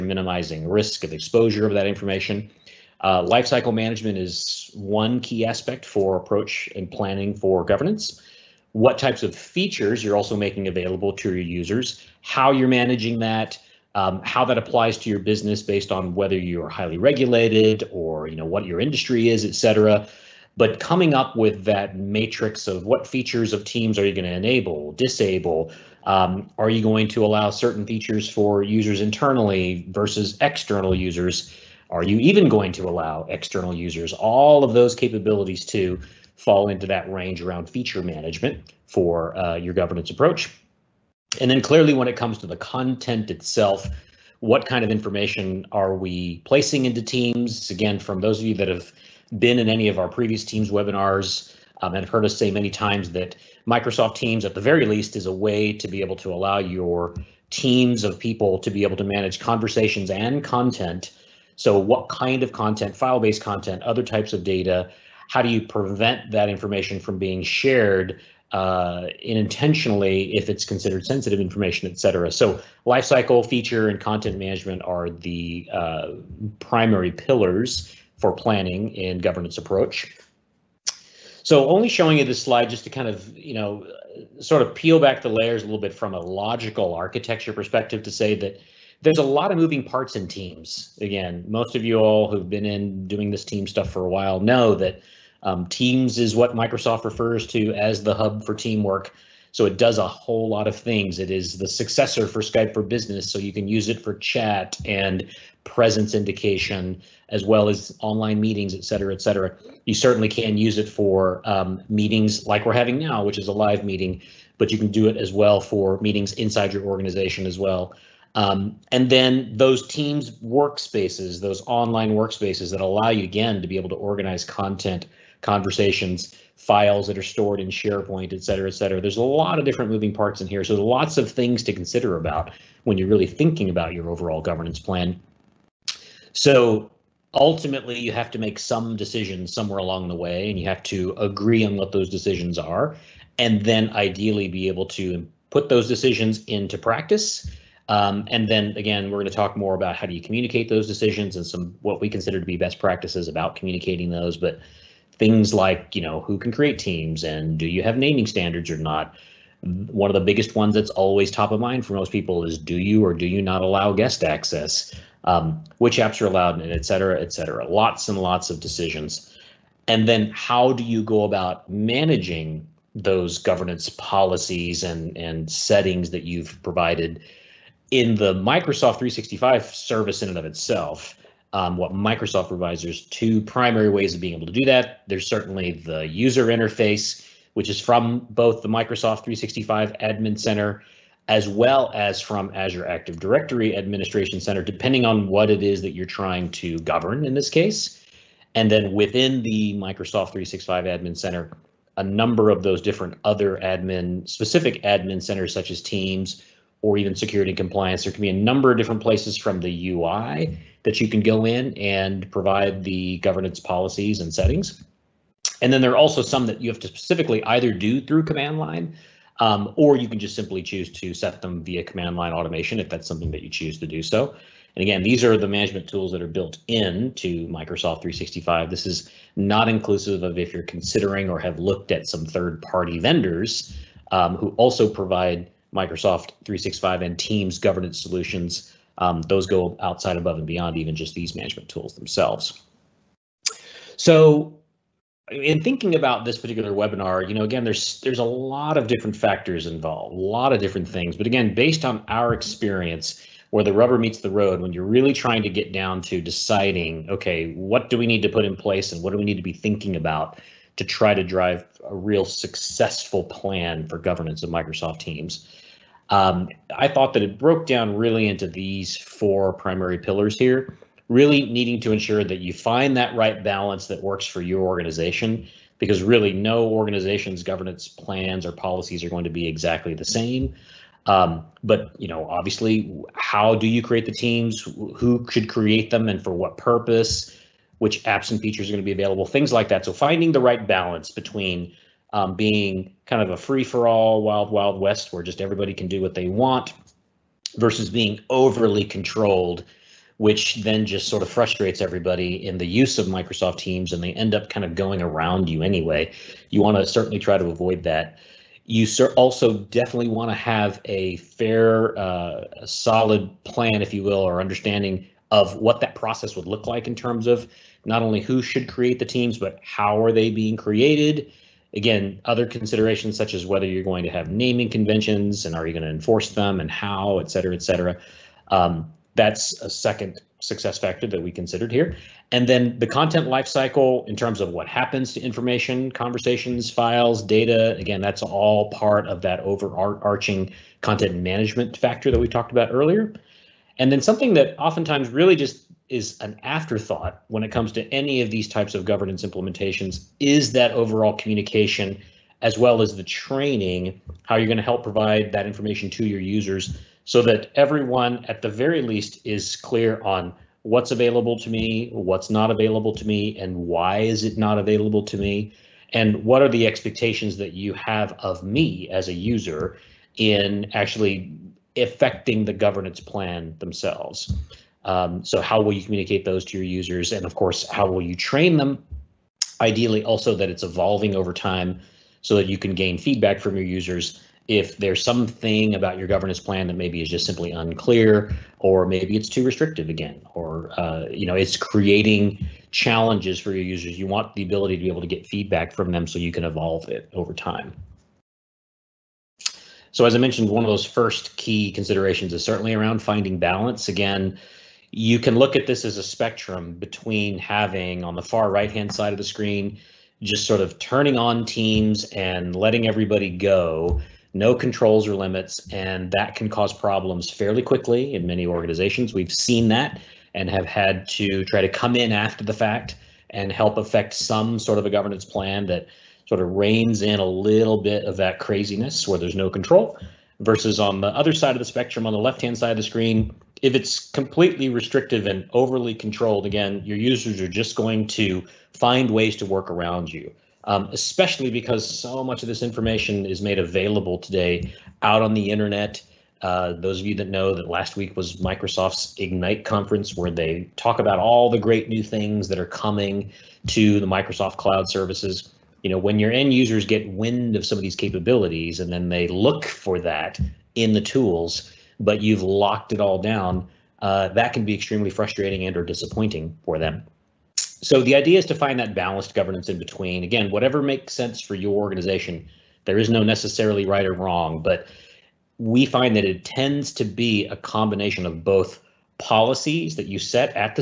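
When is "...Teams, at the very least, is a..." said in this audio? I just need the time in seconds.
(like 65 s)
54 s.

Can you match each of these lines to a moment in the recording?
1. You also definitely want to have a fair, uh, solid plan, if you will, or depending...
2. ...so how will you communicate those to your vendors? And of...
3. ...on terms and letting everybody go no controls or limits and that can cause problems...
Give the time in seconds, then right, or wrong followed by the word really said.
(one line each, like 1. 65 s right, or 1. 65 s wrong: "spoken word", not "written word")
1. 308 s wrong: "understanding", not "depending"
2. 375 s wrong: "users", not "vendors"
3. 411 s wrong: "teams", not "terms".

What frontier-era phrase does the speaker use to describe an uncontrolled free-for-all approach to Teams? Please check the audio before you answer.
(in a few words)
wild, wild west.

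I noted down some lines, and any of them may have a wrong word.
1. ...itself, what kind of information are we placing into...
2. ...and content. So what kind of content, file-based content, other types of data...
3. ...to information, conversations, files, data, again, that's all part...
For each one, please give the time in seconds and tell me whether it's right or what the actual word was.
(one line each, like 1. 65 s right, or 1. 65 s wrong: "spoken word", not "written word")
1. 43 s right
2. 60 s right
3. 335 s right.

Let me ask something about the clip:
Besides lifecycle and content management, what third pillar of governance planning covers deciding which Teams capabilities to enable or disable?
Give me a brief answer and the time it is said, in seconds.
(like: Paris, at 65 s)
feature management, at 37 s.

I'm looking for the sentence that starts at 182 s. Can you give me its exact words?
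There's two primary ways of being able to do that.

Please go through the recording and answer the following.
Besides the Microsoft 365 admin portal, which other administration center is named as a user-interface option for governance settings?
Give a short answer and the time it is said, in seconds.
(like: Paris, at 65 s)
Azure Active Directory Administration Center, at 192 s.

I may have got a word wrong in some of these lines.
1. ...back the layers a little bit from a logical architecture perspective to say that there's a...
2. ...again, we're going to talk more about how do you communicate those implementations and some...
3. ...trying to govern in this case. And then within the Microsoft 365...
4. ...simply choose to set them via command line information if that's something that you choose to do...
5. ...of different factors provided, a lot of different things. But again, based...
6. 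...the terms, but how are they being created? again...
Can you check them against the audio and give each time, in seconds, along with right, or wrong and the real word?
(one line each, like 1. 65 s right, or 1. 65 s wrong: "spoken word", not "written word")
1. 84 s right
2. 148 s wrong: "decisions", not "implementations"
3. 196 s right
4. 220 s wrong: "automation", not "information"
5. 248 s wrong: "involved", not "provided"
6. 318 s wrong: "teams", not "terms".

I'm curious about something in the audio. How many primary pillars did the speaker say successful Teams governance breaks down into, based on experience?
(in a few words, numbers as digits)
4.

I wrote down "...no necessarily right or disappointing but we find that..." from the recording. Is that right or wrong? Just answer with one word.
wrong.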